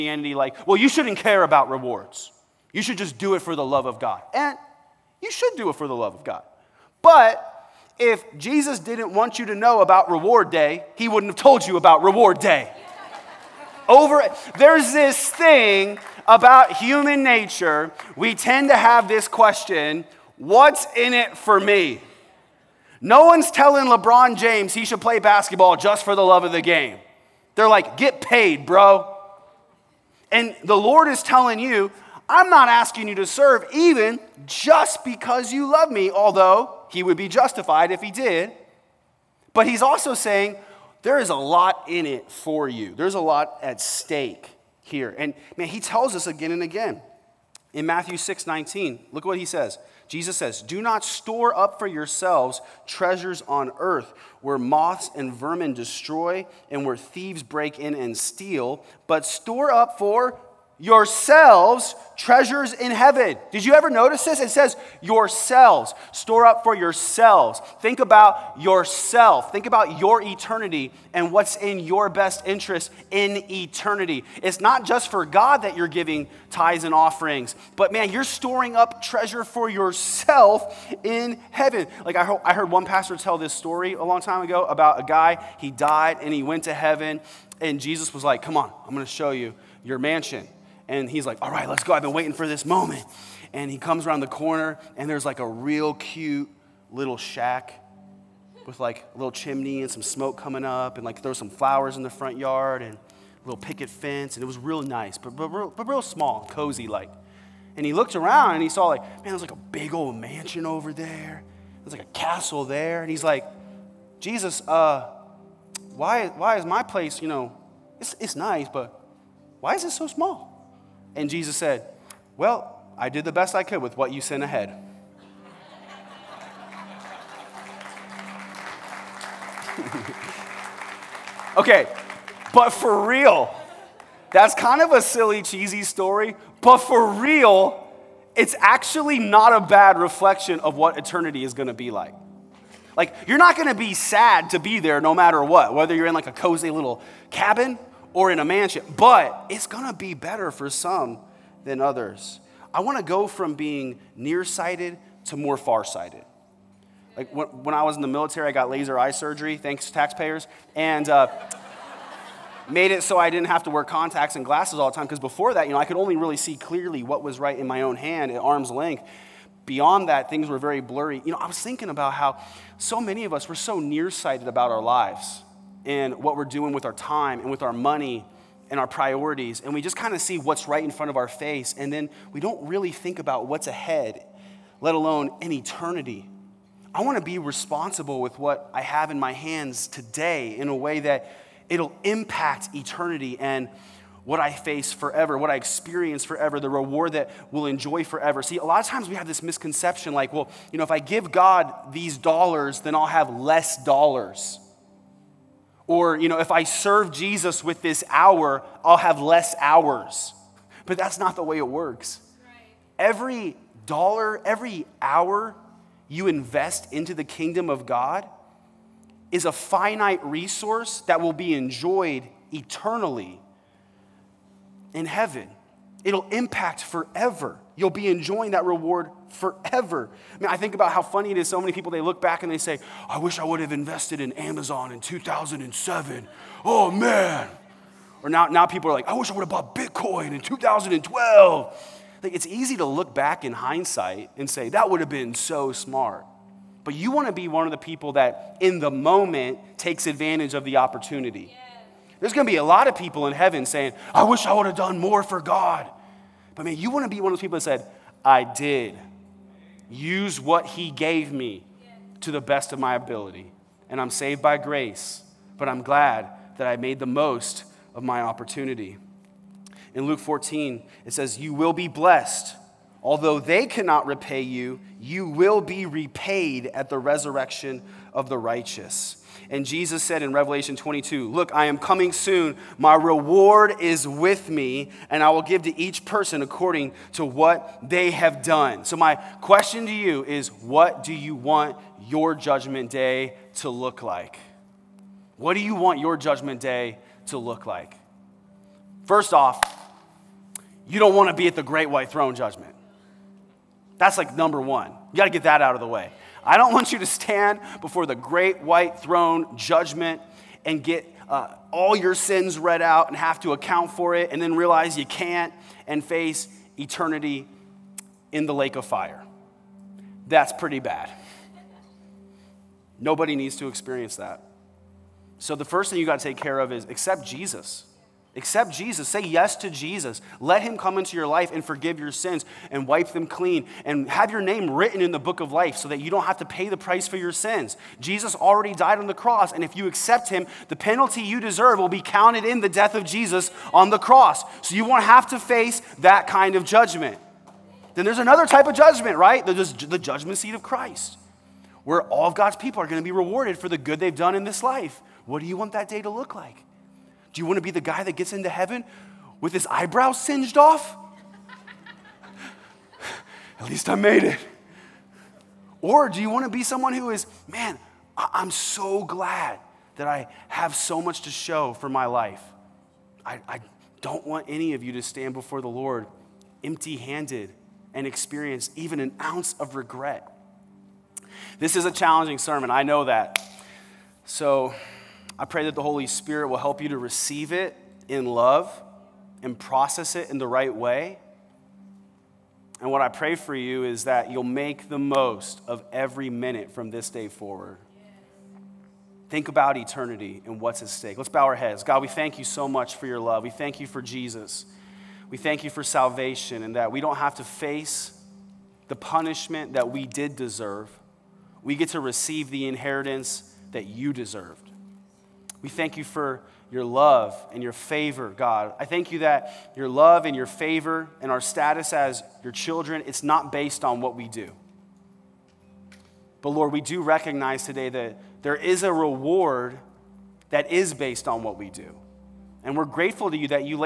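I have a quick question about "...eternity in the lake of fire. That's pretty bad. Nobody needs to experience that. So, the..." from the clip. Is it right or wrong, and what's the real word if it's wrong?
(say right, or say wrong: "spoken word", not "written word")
right.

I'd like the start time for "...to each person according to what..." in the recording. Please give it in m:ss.
4:45.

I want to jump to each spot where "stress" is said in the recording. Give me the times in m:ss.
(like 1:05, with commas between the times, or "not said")
not said.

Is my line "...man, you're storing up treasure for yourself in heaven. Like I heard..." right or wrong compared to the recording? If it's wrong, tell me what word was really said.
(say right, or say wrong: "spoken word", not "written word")
right.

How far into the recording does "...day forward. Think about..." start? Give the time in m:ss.
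6:37.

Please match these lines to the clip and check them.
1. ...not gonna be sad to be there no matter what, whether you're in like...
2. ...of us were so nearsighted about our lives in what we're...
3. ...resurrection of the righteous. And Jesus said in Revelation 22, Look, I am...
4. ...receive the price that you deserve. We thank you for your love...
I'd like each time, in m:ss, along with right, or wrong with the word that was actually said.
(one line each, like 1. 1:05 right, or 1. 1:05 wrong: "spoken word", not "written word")
1. 2:23 right
2. 2:53 right
3. 4:36 right
4. 6:52 wrong: "inheritance", not "price".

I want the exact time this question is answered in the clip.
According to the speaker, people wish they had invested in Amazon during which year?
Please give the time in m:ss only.
3:55.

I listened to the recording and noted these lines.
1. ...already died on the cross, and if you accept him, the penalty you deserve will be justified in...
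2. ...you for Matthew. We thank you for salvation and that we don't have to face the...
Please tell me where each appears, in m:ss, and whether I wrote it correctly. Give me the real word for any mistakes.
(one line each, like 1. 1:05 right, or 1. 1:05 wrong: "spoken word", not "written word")
1. 5:38 wrong: "counted", not "justified"
2. 6:43 wrong: "Jesus", not "Matthew".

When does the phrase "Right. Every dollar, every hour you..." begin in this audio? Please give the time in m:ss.
3:32.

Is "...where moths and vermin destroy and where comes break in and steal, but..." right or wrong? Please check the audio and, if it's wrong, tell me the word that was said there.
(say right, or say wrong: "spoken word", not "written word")
wrong: "thieves", not "comes".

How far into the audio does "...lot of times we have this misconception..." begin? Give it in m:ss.
3:18.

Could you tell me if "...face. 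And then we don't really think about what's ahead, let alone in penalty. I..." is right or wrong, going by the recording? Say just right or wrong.
wrong.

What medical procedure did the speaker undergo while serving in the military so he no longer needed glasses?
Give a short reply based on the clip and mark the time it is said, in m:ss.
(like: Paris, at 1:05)
Laser eye surgery, at 2:38.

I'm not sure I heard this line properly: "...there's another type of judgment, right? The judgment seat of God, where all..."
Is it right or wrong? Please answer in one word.
wrong.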